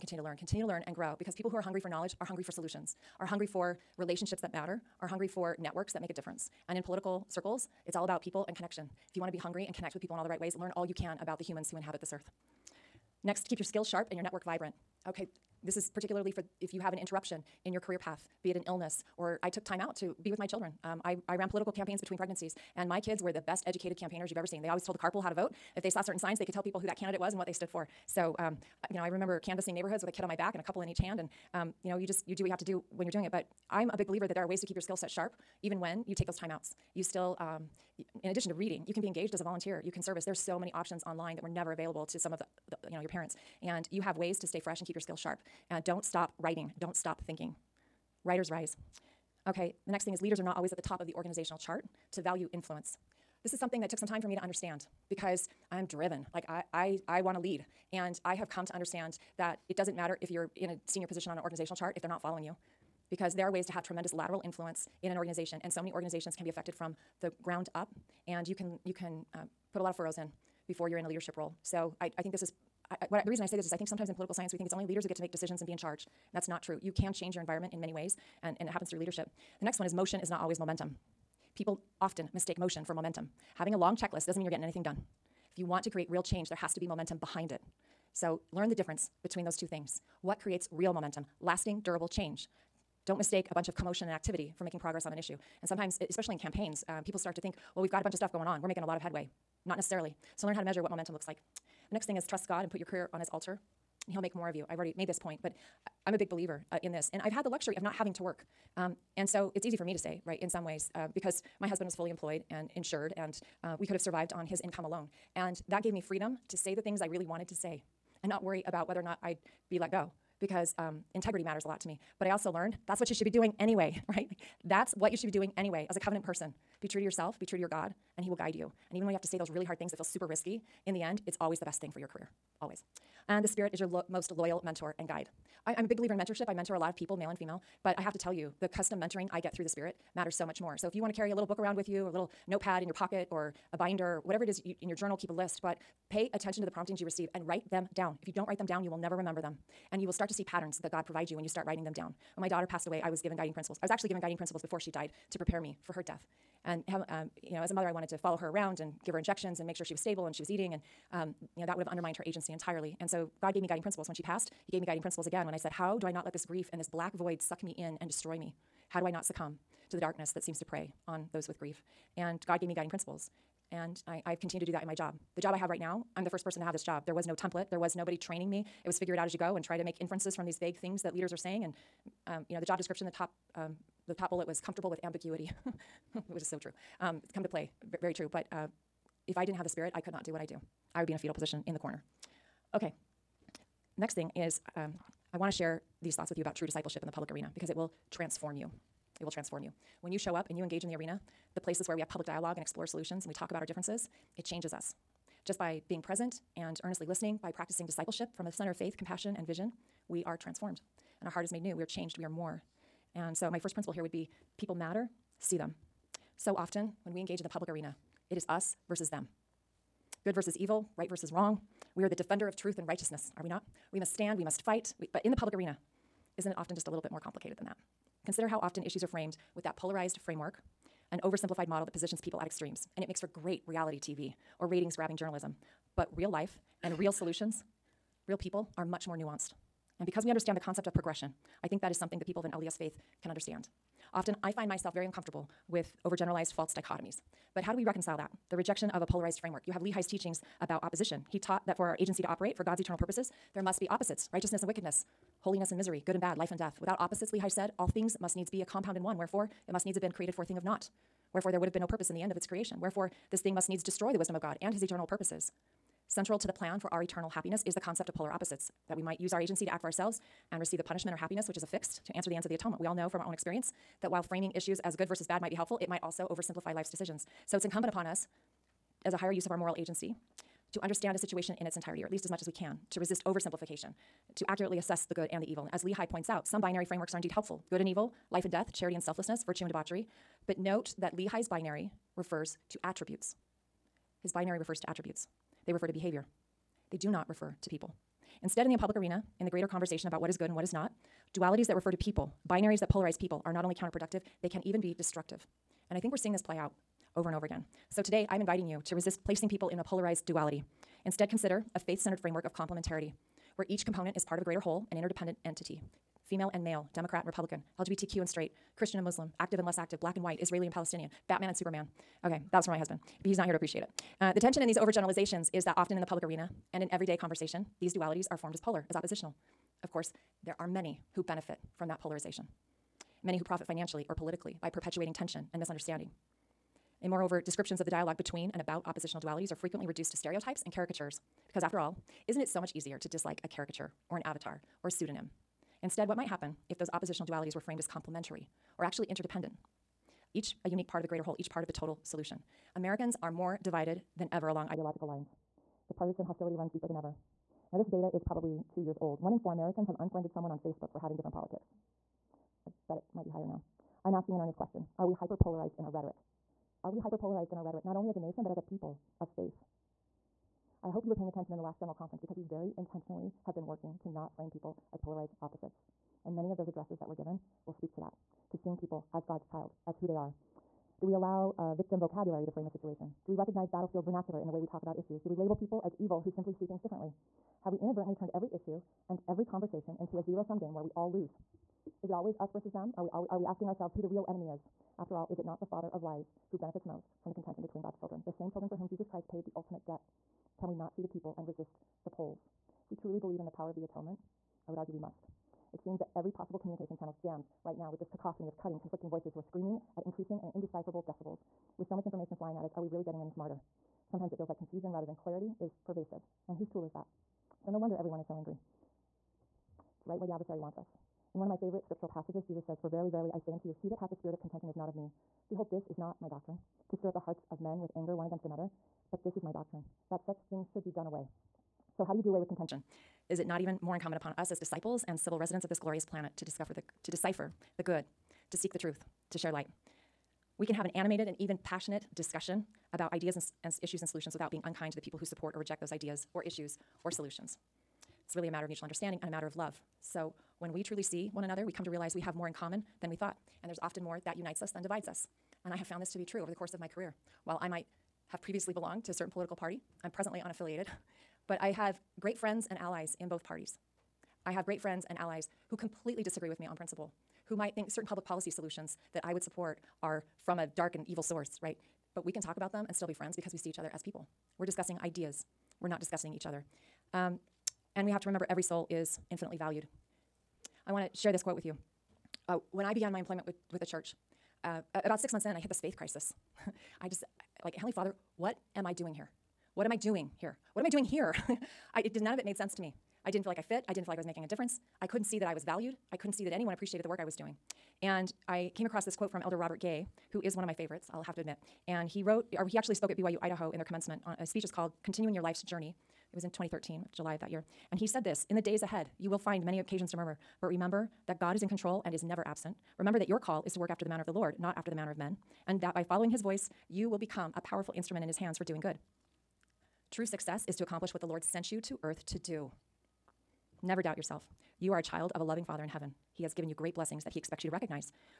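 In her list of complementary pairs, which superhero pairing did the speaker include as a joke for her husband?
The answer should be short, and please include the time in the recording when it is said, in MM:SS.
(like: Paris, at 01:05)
Batman and Superman, at 05:21.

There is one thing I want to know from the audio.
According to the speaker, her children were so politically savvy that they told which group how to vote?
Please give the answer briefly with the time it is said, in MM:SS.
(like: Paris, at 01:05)
The carpool, at 00:24.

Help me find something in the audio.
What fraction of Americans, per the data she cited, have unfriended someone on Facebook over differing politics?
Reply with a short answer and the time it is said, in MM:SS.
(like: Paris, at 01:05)
One in four, at 05:59.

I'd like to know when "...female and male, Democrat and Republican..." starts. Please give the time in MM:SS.
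05:16.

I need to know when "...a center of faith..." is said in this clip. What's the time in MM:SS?
03:28.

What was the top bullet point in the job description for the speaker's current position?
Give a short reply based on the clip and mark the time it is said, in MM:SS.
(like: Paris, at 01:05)
Comfortable with ambiguity, at 03:04.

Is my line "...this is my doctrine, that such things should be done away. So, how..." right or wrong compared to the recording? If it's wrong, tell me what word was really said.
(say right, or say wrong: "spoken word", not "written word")
right.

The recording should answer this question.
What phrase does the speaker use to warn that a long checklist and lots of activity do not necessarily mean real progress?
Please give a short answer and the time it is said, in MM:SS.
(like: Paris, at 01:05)
Motion is not always momentum, at 01:19.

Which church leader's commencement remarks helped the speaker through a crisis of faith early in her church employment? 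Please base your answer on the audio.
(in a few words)
Elder Robert Gay.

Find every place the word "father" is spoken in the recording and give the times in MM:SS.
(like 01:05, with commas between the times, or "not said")
06:35, 08:07, 08:45.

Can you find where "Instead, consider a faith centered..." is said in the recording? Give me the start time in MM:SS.
05:11.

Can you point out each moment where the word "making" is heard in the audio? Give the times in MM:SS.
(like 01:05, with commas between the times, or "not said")
01:34, 01:38, 08:14.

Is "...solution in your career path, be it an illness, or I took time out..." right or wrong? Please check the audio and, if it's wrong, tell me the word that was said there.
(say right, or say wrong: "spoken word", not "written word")
wrong: "interruption", not "solution".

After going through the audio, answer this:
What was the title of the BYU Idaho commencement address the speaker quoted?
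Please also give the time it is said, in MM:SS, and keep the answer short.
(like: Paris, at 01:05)
Continuing Your Life's Journey, at 08:25.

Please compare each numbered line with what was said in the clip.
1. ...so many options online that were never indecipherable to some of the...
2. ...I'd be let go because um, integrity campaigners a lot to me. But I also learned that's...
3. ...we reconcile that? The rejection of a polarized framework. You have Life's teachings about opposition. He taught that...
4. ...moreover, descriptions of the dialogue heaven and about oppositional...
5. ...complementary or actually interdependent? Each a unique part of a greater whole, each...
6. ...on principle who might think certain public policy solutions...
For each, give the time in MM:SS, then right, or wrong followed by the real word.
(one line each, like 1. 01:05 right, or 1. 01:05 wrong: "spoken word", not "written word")
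1. 00:40 wrong: "available", not "indecipherable"
2. 01:59 wrong: "matters", not "campaigners"
3. 04:07 wrong: "Lehi", not "Life"
4. 05:37 wrong: "between", not "heaven"
5. 05:47 right
6. 07:46 right.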